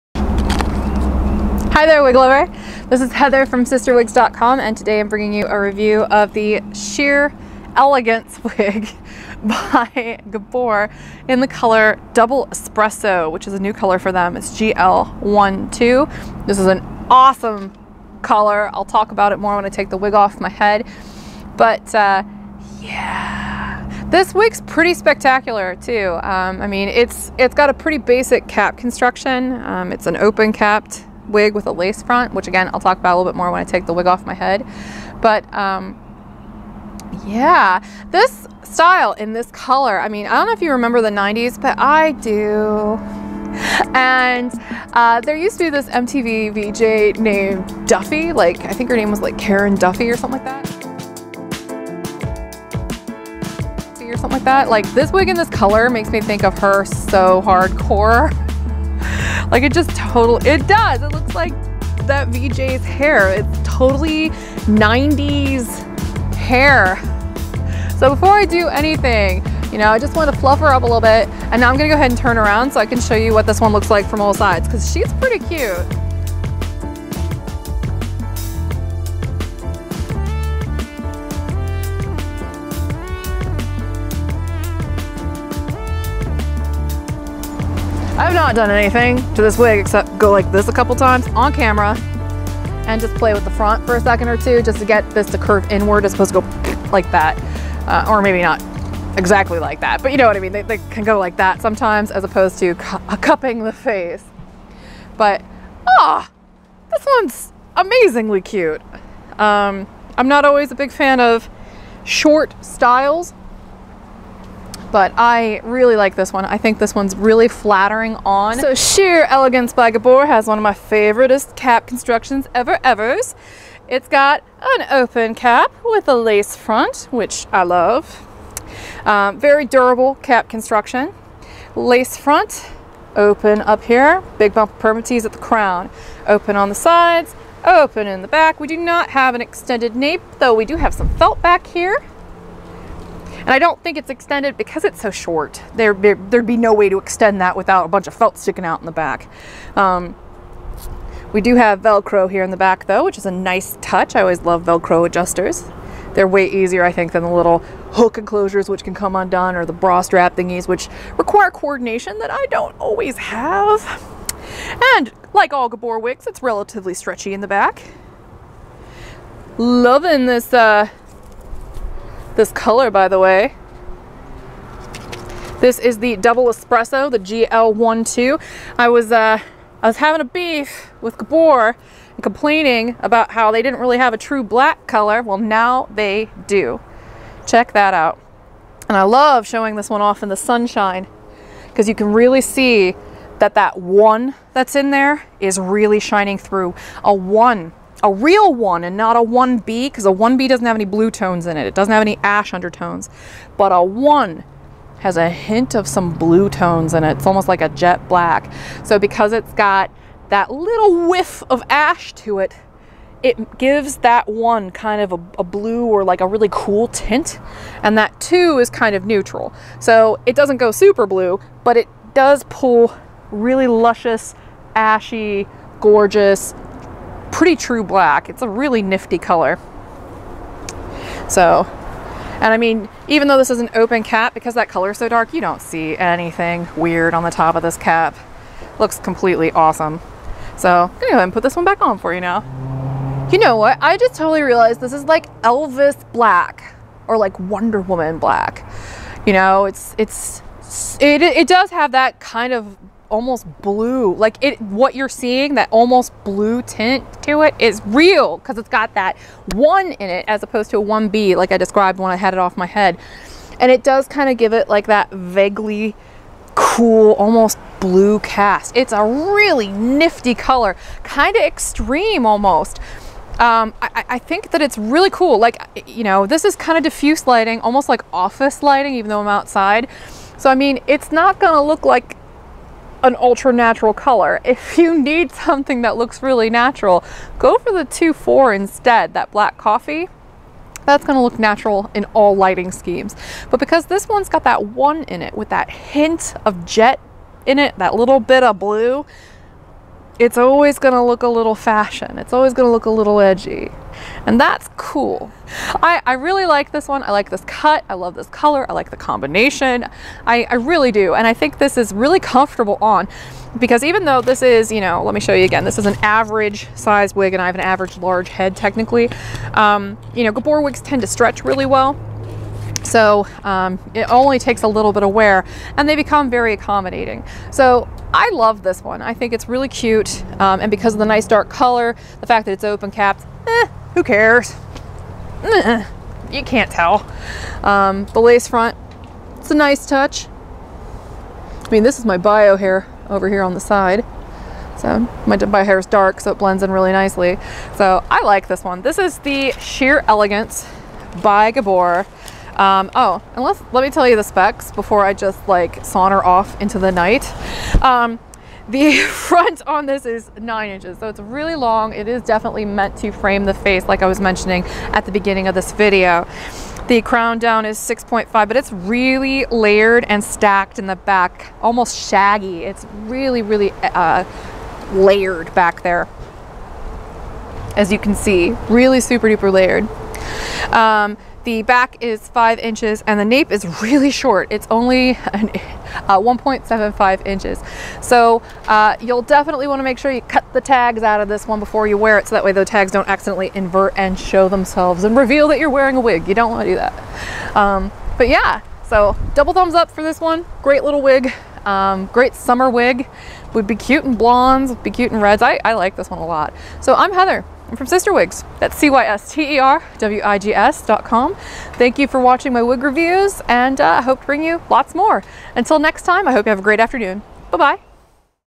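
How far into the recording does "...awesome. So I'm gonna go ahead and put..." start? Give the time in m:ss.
3:59.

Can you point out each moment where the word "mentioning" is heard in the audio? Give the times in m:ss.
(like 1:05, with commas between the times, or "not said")
6:04.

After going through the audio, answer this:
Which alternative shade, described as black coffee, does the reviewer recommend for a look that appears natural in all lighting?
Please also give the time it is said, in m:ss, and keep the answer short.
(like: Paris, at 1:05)
2-4, at 4:47.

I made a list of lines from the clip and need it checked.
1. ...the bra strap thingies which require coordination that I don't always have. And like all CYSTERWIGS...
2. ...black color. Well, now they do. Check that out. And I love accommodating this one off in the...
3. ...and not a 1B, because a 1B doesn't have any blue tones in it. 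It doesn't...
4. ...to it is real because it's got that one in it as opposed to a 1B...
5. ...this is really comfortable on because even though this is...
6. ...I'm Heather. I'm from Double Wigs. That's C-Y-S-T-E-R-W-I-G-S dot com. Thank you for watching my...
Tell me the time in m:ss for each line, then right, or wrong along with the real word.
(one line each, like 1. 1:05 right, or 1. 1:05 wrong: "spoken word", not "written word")
1. 2:39 wrong: "Gabor", not "CYSTERWIGS"
2. 3:04 wrong: "showing", not "accommodating"
3. 3:18 right
4. 4:17 right
5. 5:11 right
6. 6:46 wrong: "Cyster", not "Double".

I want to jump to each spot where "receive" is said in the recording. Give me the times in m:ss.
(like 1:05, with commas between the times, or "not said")
not said.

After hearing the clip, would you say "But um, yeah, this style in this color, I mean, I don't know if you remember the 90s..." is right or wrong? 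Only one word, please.
right.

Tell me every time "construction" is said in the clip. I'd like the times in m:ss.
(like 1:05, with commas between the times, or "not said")
0:28, 2:01, 2:10.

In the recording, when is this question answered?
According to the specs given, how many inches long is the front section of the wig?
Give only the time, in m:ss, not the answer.
6:00.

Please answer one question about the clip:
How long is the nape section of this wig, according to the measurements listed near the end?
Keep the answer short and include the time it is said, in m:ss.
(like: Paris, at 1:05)
1.75 inches, at 6:26.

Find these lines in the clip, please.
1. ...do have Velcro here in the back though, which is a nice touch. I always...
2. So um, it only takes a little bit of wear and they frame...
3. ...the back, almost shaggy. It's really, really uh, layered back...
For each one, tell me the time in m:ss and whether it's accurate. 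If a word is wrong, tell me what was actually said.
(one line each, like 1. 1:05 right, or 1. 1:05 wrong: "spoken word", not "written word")
1. 2:31 right
2. 5:22 wrong: "become", not "frame"
3. 6:10 right.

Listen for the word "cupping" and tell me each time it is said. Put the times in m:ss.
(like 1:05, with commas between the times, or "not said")
1:43.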